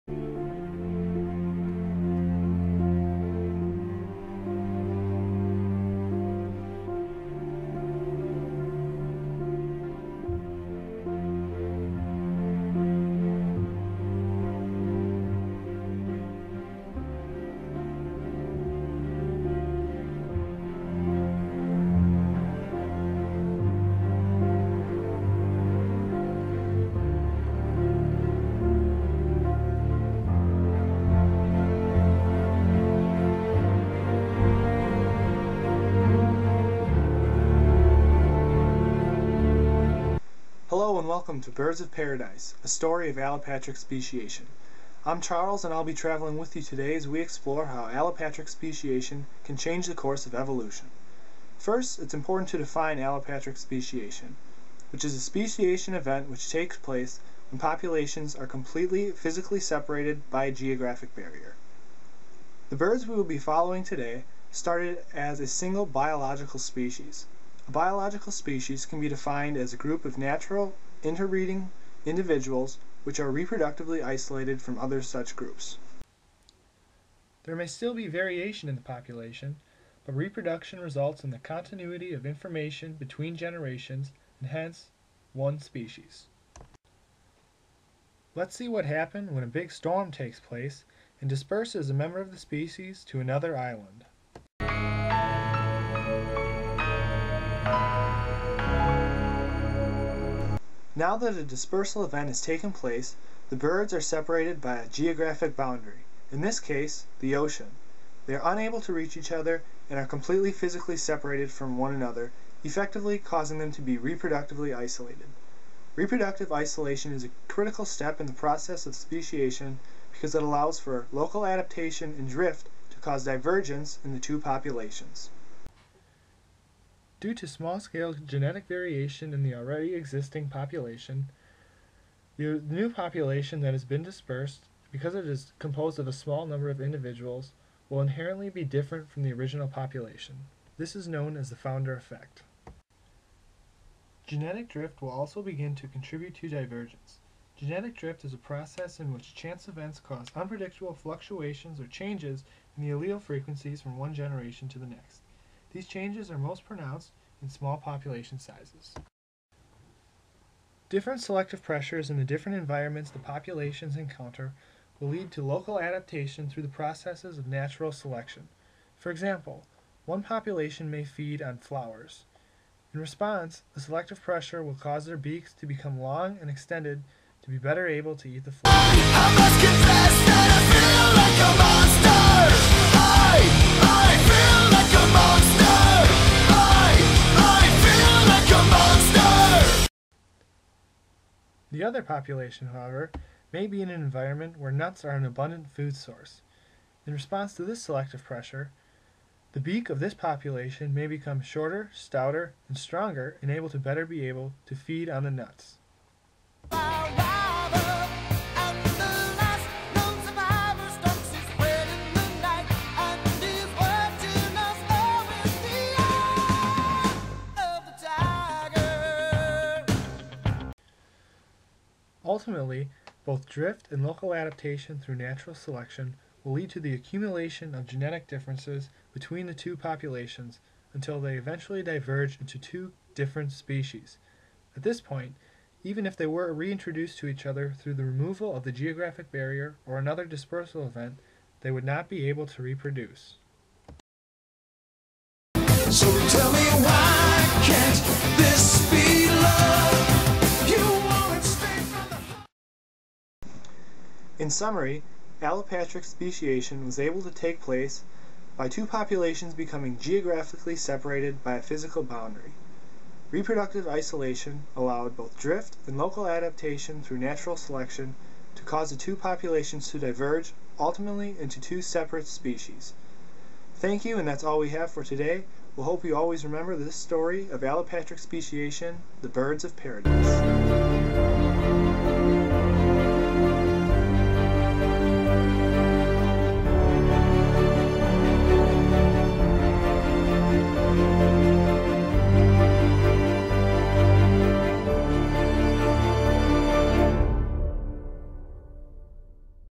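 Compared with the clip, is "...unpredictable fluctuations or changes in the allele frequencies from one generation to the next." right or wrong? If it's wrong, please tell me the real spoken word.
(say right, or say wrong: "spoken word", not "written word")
right.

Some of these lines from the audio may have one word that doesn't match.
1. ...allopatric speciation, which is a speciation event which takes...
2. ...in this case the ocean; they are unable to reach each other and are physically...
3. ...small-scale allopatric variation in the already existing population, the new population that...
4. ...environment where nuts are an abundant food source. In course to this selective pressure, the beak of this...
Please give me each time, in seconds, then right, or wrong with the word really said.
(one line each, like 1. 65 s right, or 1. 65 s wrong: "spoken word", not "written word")
1. 52 s right
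2. 106 s wrong: "completely", not "physically"
3. 127 s wrong: "genetic", not "allopatric"
4. 194 s wrong: "response", not "course".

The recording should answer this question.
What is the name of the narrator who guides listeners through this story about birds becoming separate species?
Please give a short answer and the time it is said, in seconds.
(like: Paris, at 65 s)
Charles, at 45 s.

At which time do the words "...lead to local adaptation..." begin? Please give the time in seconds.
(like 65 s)
165 s.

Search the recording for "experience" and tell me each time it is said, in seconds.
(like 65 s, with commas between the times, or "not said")
not said.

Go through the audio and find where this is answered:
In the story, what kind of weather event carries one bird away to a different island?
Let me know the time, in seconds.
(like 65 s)
89 s.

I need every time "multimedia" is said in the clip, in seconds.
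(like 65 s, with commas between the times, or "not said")
not said.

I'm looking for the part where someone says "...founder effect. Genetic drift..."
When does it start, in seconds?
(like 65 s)
141 s.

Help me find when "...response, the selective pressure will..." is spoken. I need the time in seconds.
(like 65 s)
172 s.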